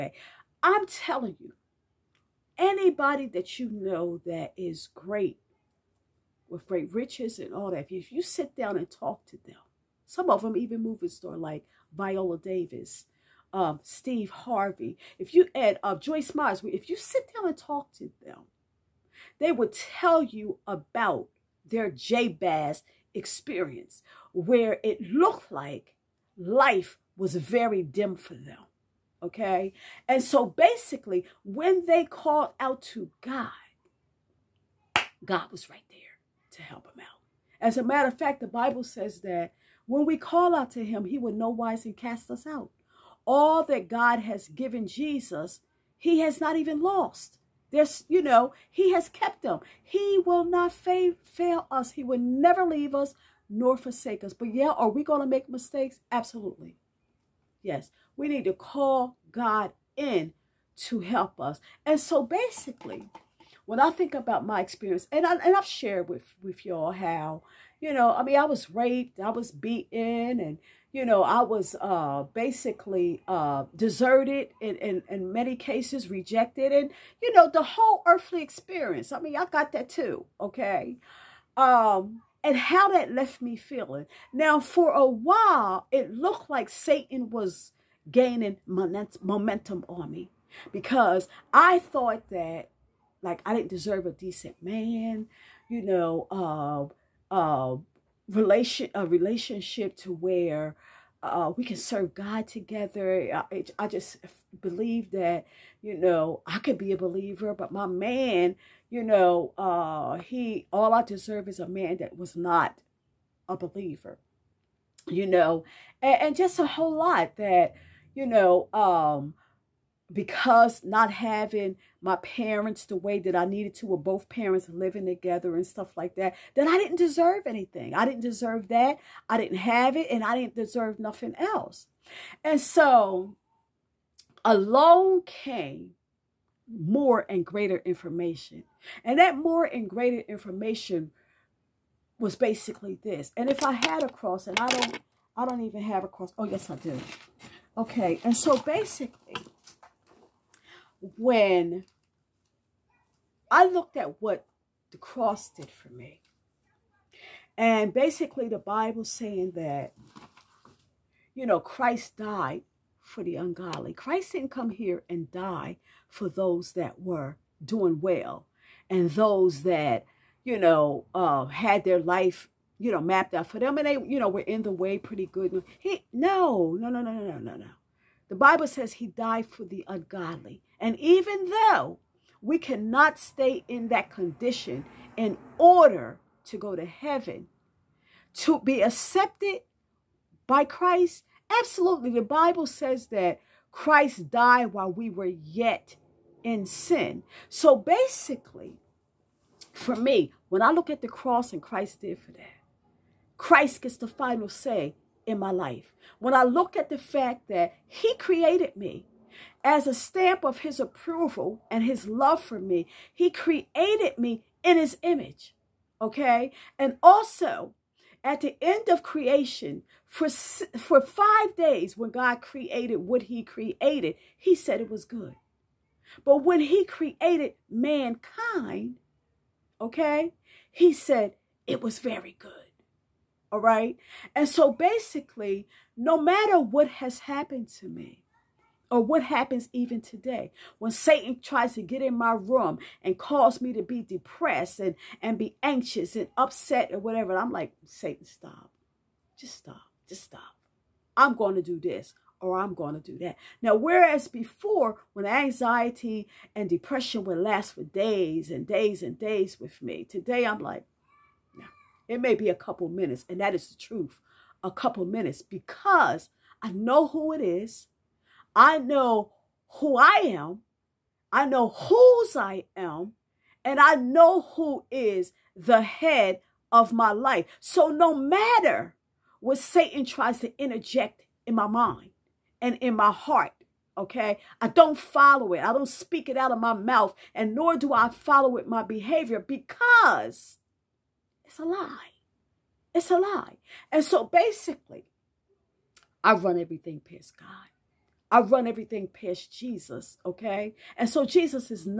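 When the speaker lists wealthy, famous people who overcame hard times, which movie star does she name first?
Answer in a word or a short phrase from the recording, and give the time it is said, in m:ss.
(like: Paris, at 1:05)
Viola Davis, at 0:11.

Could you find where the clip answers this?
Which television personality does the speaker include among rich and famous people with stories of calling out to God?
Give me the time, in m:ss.
0:13.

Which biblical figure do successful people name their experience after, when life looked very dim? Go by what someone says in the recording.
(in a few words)
Jabez.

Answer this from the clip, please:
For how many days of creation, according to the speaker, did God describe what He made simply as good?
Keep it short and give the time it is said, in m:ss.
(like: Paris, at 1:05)
5 days, at 3:41.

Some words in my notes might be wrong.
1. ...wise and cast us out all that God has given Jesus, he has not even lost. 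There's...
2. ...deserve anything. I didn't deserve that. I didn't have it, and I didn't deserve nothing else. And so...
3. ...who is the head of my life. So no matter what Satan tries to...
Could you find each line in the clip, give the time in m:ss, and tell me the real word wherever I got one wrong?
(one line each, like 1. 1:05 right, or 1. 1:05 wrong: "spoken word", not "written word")
1. 0:41 right
2. 2:06 right
3. 4:34 right.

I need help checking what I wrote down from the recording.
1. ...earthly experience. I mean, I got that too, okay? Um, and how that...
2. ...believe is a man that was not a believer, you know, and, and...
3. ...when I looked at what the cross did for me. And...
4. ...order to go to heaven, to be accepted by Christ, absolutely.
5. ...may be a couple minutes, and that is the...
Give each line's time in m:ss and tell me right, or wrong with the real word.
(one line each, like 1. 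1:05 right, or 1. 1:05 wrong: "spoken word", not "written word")
1. 1:18 right
2. 1:51 wrong: "deserve", not "believe"
3. 2:31 right
4. 3:05 right
5. 4:22 right.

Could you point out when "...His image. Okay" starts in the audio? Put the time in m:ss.
3:34.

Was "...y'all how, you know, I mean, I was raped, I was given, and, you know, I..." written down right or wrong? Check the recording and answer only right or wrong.
wrong.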